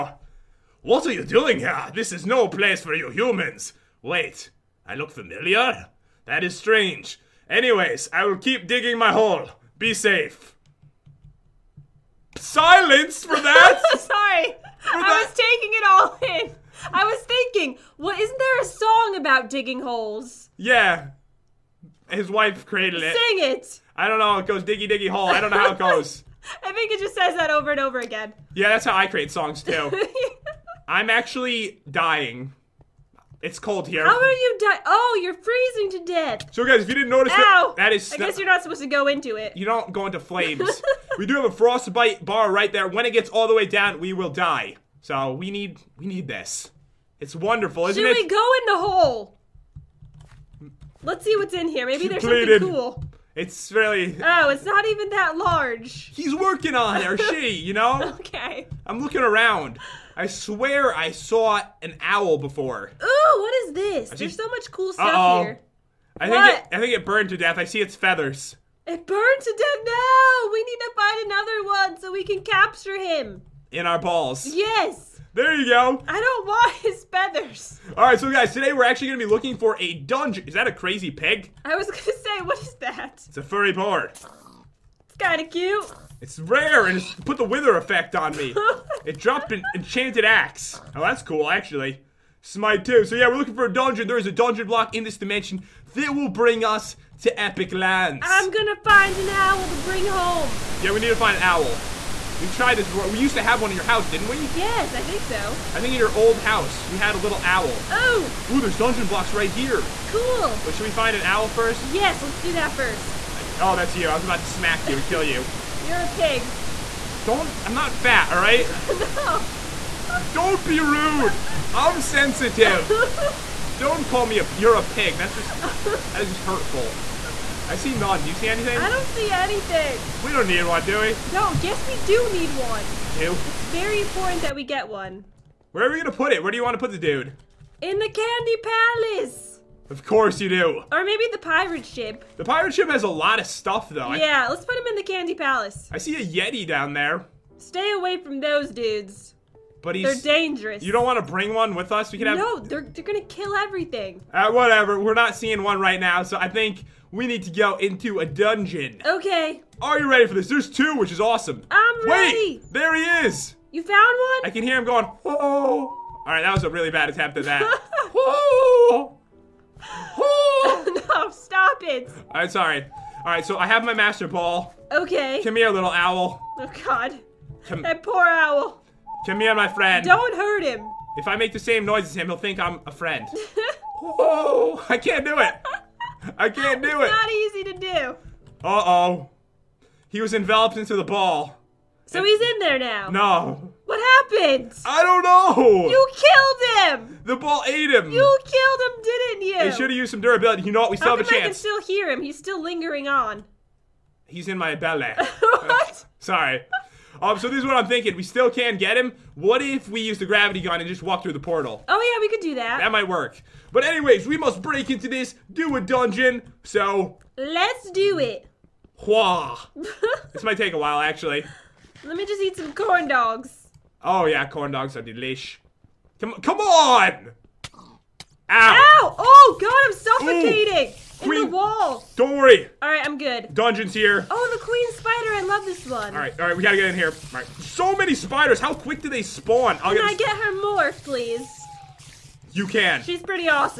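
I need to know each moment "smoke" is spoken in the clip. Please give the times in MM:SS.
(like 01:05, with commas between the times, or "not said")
not said.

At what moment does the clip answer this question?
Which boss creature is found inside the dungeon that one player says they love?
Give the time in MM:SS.
03:54.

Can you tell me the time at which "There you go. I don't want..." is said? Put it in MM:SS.
01:15.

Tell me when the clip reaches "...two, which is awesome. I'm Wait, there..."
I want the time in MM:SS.
02:40.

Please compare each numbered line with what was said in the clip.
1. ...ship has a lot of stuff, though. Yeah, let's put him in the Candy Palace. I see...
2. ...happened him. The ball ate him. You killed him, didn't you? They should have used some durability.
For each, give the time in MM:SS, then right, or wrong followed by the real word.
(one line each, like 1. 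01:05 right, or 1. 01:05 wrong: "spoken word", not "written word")
1. 02:22 right
2. 03:16 wrong: "killed", not "happened".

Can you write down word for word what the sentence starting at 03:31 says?
Oh yeah, we could do that.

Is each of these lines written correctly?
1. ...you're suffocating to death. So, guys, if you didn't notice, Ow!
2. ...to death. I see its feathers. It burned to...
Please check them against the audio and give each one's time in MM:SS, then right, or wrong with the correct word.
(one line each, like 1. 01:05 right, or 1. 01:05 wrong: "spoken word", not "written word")
1. 00:35 wrong: "freezing", not "suffocating"
2. 01:07 right.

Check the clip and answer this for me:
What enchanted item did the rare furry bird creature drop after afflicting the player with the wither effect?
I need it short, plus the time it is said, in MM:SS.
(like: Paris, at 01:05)
Enchanted axe, at 01:29.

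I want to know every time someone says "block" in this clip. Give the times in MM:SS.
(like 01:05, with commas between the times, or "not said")
01:34, 01:49.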